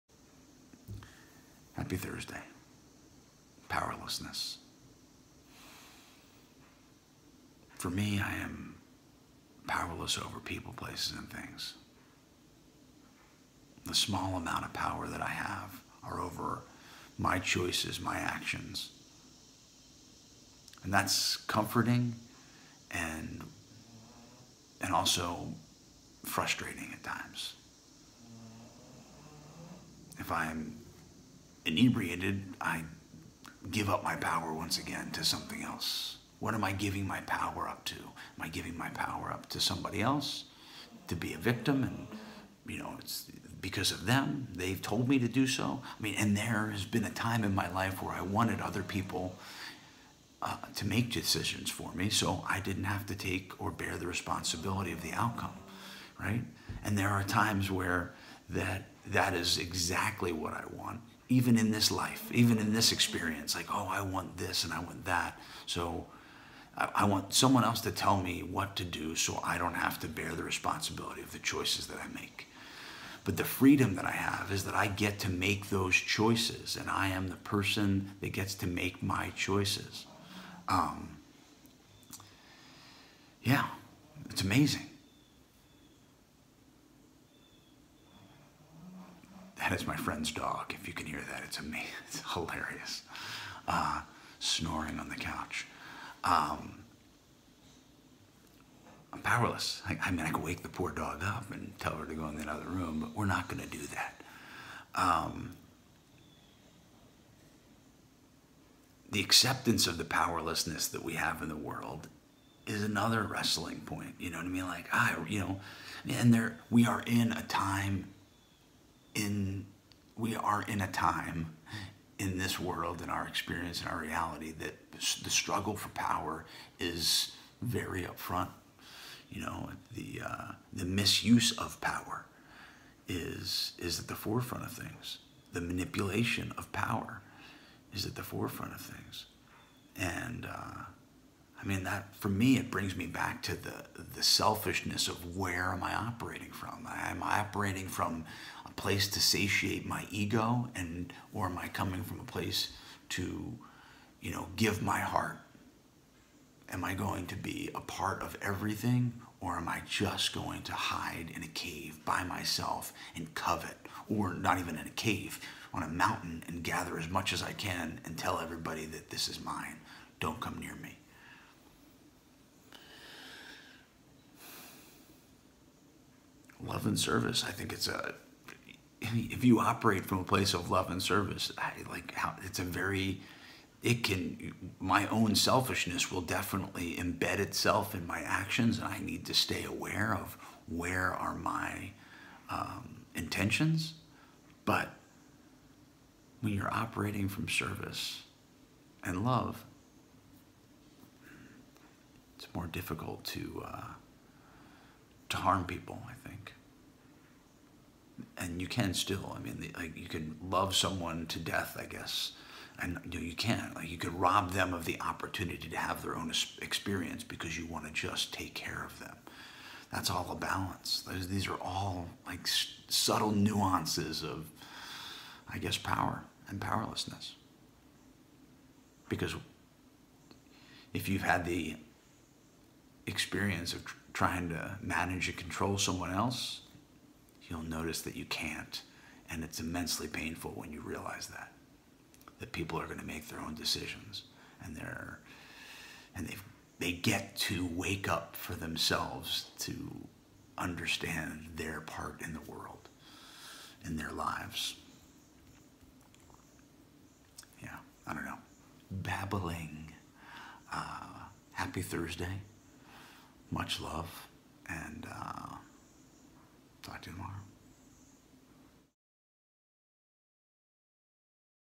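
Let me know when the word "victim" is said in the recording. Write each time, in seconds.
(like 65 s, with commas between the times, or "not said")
41 s.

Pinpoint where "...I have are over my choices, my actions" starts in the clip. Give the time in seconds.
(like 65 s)
15 s.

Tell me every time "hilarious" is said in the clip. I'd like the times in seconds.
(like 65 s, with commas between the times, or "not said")
92 s.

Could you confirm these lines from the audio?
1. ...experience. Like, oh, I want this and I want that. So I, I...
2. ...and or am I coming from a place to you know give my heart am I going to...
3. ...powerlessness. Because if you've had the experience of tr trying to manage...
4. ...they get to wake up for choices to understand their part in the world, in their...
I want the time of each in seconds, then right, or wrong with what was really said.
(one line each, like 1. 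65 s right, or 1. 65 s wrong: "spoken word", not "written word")
1. 62 s right
2. 150 s right
3. 226 s right
4. 246 s wrong: "themselves", not "choices".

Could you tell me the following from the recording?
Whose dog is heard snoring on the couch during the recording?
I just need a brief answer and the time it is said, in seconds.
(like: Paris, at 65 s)
Friend's dog, at 89 s.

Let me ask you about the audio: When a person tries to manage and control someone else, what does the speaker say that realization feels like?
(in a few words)
Immensely painful.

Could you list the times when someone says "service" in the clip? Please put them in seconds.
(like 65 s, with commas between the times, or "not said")
176 s, 181 s, 197 s.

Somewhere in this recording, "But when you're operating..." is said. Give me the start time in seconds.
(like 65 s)
194 s.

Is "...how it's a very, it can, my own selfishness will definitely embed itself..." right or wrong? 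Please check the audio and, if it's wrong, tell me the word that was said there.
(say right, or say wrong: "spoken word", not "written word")
right.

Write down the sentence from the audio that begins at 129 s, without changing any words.
You know, the uh, the misuse of power is is at the forefront of things.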